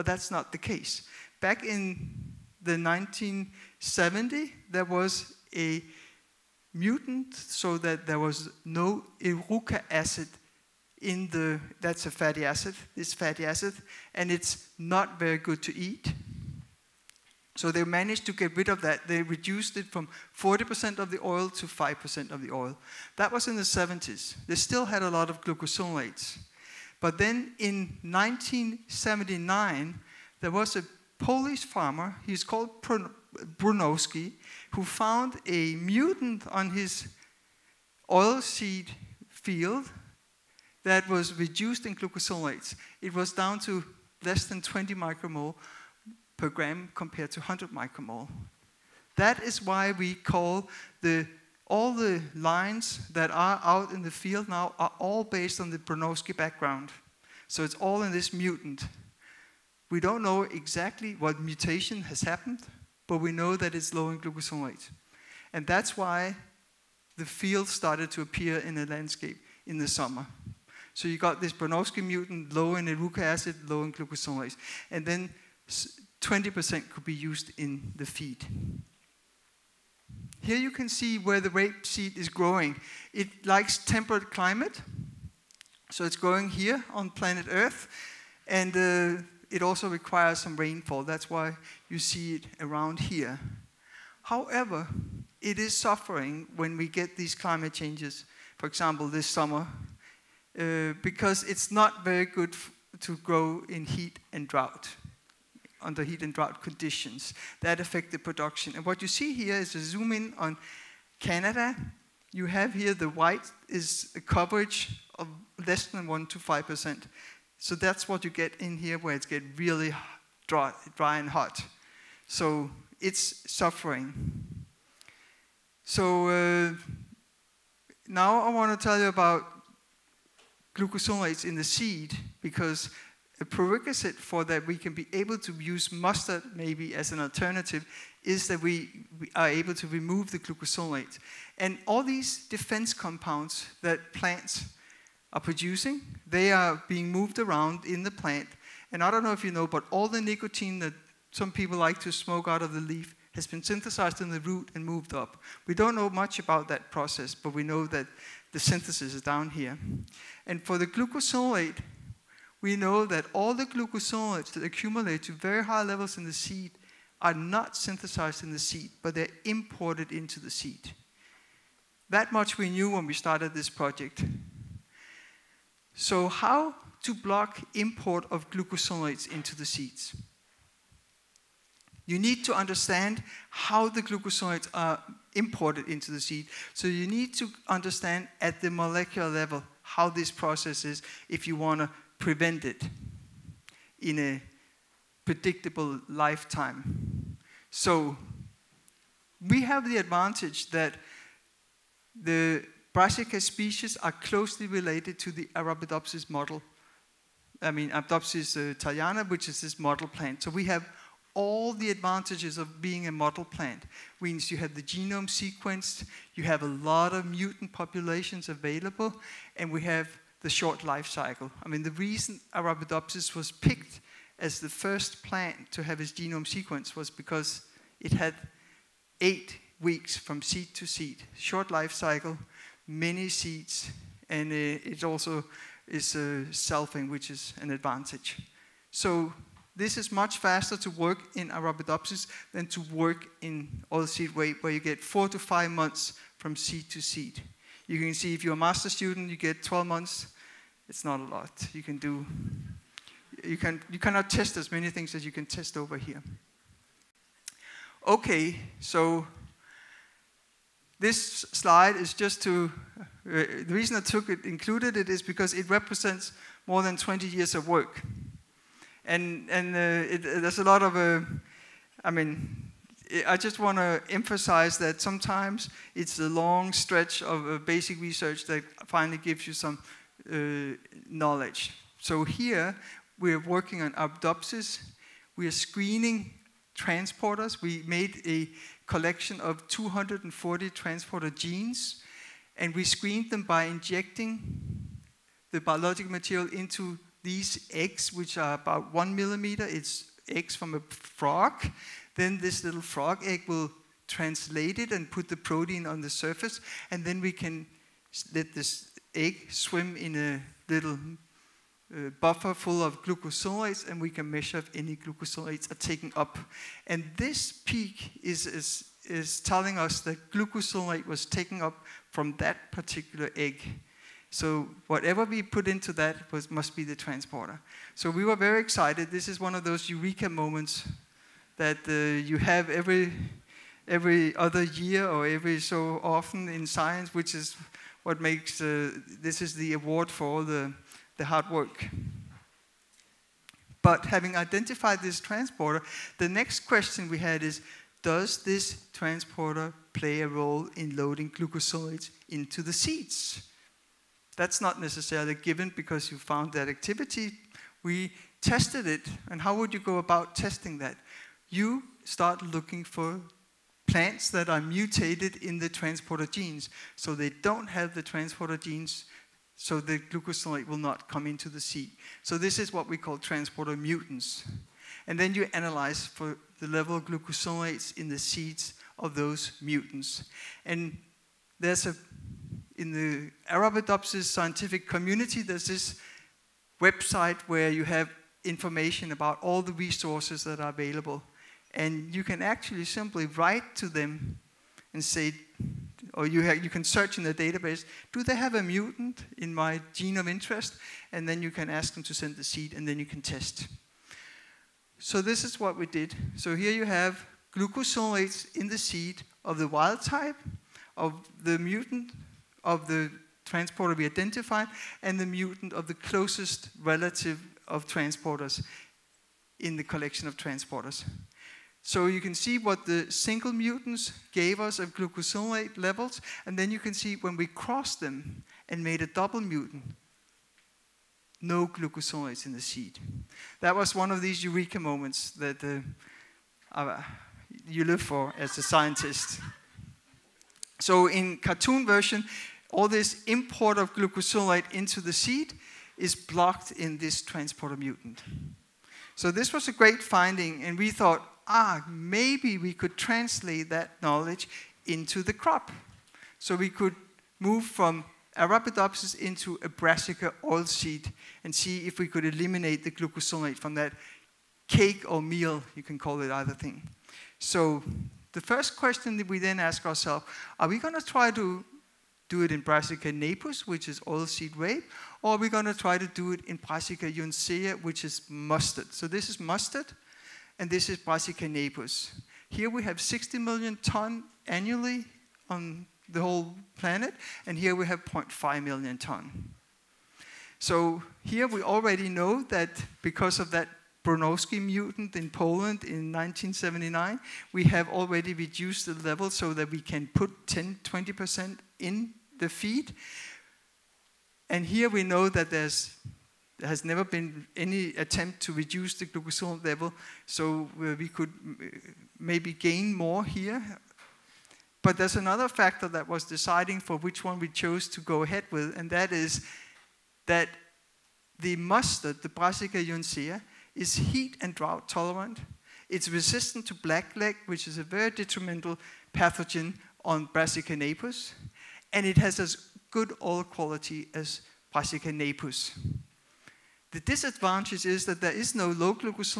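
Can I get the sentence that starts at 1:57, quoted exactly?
So that's what you get in here where it's get really dry, dry and hot.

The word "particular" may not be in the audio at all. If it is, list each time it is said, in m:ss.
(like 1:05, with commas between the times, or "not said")
5:22.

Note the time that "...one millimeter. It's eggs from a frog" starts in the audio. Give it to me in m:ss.
4:58.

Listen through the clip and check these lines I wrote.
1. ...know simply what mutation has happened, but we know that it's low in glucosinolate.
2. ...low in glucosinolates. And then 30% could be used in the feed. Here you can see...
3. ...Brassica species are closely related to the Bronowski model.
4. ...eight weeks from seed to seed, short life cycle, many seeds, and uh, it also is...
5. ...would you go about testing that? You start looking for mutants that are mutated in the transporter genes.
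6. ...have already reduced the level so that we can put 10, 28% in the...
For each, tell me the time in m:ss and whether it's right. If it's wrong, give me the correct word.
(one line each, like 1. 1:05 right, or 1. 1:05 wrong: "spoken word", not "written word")
1. 1:00 wrong: "exactly", not "simply"
2. 1:13 wrong: "20", not "30"
3. 3:22 wrong: "Arabidopsis", not "Bronowski"
4. 3:49 right
5. 5:59 wrong: "plants", not "mutants"
6. 8:17 wrong: "20", not "28".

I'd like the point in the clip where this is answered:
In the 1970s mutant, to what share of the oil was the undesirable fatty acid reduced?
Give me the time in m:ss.
0:21.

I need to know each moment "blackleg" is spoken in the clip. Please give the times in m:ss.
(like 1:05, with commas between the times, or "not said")
8:46.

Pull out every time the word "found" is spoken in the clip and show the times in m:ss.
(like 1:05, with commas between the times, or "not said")
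0:34, 5:56.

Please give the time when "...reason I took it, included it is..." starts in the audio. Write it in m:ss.
4:23.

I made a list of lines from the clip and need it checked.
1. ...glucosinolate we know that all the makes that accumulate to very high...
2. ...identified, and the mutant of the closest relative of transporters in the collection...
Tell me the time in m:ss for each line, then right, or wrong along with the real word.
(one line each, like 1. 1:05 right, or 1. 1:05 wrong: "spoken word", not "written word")
1. 2:40 wrong: "glucosides", not "makes"
2. 6:54 right.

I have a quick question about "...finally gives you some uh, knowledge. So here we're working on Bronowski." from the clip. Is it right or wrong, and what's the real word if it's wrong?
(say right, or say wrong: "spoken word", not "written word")
wrong: "Arabidopsis", not "Bronowski".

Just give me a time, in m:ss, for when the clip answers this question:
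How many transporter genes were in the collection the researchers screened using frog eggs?
4:49.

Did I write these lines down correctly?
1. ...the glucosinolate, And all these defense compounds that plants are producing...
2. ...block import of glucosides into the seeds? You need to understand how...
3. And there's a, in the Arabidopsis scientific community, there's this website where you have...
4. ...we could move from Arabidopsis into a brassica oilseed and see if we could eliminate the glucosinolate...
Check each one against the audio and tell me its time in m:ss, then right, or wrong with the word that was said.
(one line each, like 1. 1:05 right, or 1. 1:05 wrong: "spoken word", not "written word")
1. 2:20 right
2. 2:57 right
3. 6:20 right
4. 7:36 right.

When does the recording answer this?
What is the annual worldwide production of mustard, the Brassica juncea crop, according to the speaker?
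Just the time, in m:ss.
8:08.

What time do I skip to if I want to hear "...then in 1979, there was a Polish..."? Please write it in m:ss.
0:27.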